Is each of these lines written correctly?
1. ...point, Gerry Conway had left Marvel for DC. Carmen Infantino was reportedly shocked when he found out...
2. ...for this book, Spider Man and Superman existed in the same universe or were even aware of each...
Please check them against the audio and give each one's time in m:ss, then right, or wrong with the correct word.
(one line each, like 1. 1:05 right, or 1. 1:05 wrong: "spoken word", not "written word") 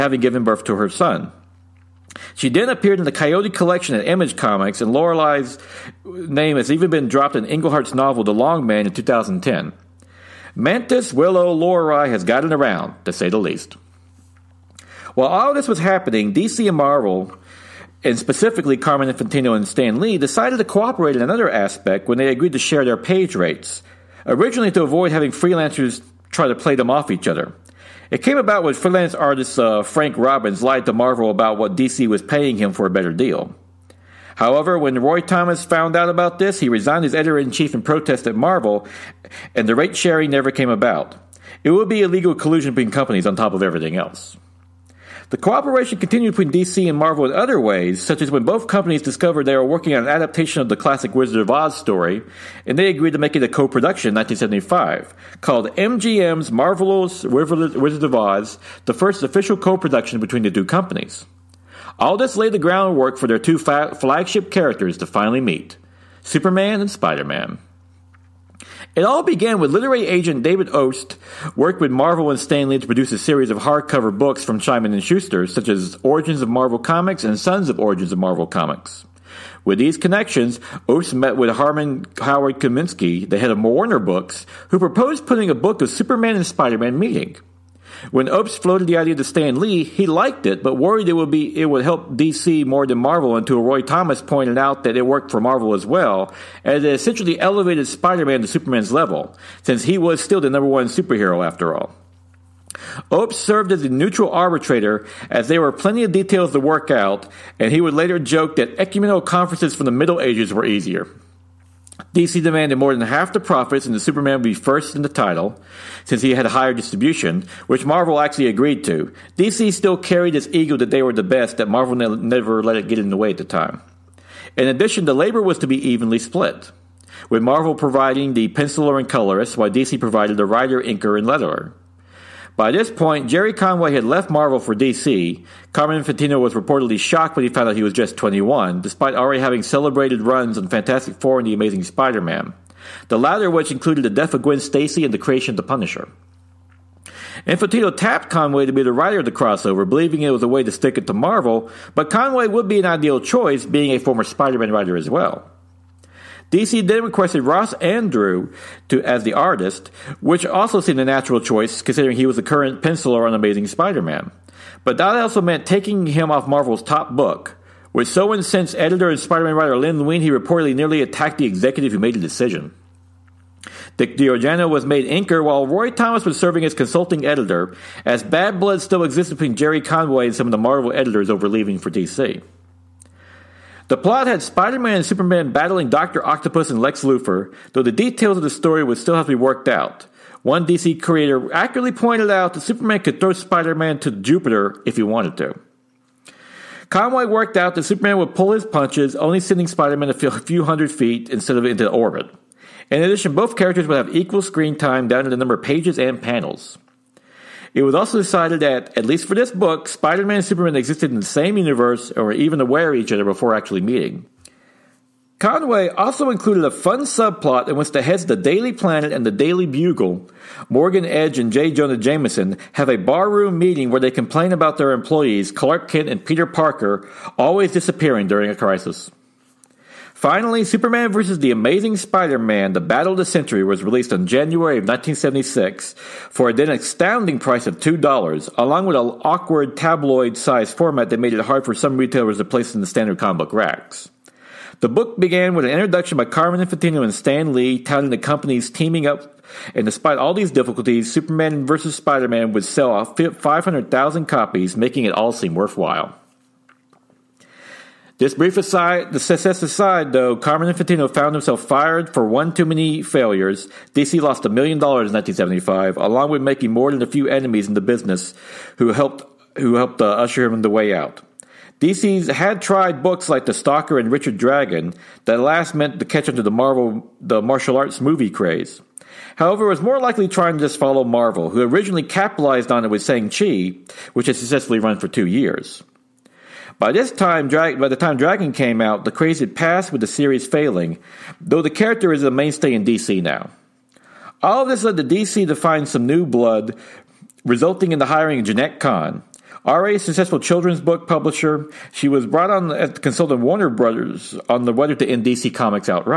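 1. 2:12 right
2. 3:29 right.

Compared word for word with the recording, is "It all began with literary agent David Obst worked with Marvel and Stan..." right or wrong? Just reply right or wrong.
right.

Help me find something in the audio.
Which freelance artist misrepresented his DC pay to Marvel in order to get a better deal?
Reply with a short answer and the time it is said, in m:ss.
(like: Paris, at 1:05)
Frank Robbins, at 0:29.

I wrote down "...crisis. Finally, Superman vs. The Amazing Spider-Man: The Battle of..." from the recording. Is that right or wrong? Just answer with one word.
right.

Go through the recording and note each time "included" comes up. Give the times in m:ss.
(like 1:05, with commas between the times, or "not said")
2:23, 3:36.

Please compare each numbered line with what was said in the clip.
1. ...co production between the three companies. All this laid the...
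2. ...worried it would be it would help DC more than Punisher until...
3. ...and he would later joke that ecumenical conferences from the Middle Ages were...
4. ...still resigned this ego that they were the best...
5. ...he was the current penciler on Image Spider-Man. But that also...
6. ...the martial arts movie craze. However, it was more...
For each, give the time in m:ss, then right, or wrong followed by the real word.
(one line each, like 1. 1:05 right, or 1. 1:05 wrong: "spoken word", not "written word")
1. 0:59 wrong: "two", not "three"
2. 1:30 wrong: "Marvel", not "Punisher"
3. 1:47 right
4. 1:59 wrong: "carried", not "resigned"
5. 2:42 wrong: "Amazing", not "Image"
6. 4:37 right.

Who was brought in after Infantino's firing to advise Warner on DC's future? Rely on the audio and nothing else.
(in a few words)
Jeanette Kahn.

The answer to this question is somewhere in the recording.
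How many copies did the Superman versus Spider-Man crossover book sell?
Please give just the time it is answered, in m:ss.
4:13.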